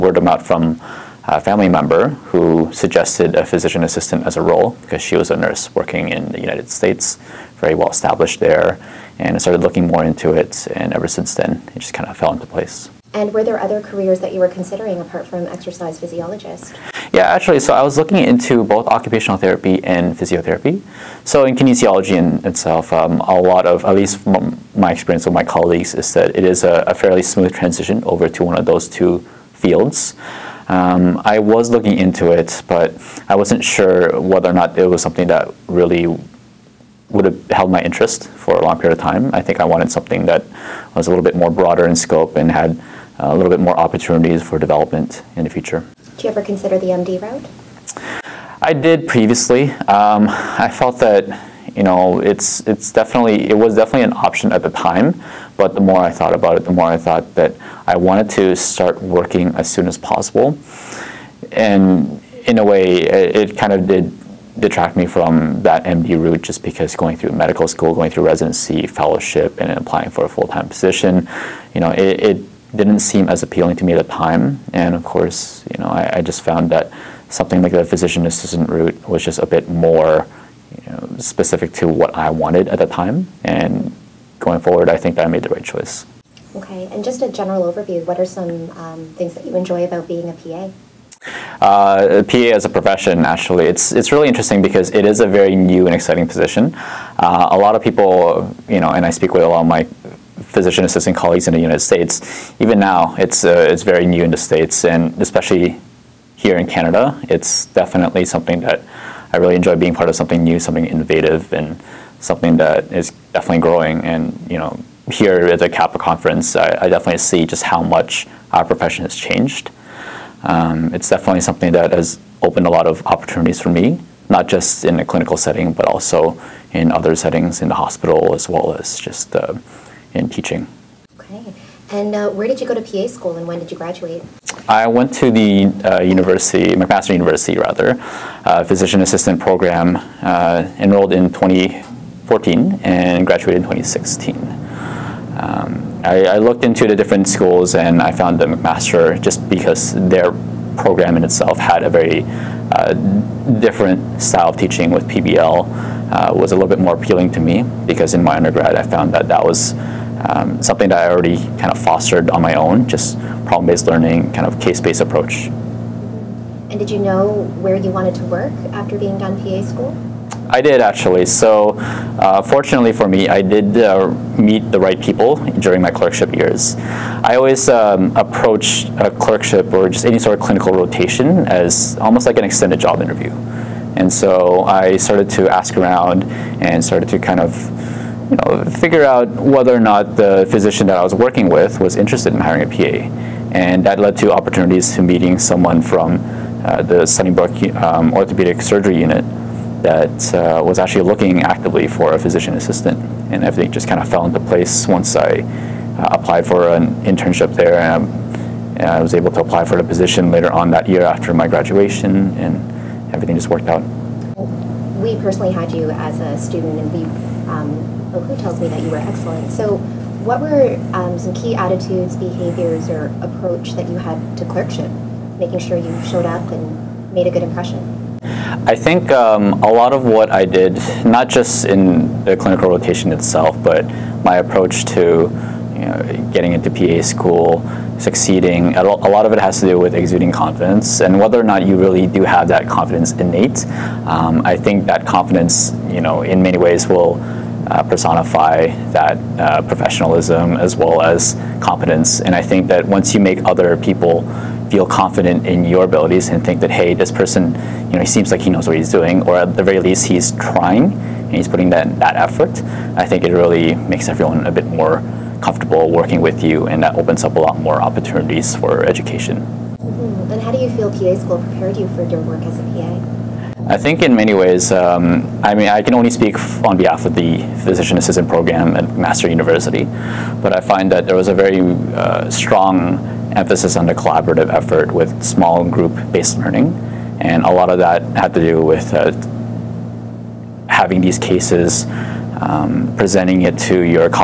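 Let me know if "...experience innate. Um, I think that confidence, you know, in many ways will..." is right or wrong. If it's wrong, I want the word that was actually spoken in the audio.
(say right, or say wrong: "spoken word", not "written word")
wrong: "confidence", not "experience".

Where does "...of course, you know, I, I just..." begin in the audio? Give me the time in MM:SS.
01:14.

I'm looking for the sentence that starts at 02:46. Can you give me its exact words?
And did you know where you wanted to work after being done PA school?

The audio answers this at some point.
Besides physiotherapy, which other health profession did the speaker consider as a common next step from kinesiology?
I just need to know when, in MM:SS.
00:18.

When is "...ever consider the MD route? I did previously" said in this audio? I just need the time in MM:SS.
00:46.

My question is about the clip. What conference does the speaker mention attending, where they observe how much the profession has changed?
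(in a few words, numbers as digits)
CAPA conference.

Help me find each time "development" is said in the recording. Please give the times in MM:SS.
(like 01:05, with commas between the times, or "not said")
00:44.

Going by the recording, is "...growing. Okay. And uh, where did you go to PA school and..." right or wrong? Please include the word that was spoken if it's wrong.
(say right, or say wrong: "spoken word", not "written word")
wrong: "teaching", not "growing".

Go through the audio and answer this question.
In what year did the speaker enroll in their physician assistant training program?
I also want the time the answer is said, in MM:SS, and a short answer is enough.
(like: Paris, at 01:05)
2014, at 02:21.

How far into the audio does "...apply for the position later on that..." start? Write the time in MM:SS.
03:29.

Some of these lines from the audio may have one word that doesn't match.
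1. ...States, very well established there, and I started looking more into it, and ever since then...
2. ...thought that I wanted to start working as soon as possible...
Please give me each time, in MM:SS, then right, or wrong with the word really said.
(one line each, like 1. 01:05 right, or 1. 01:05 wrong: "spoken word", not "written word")
1. 00:06 right
2. 00:56 right.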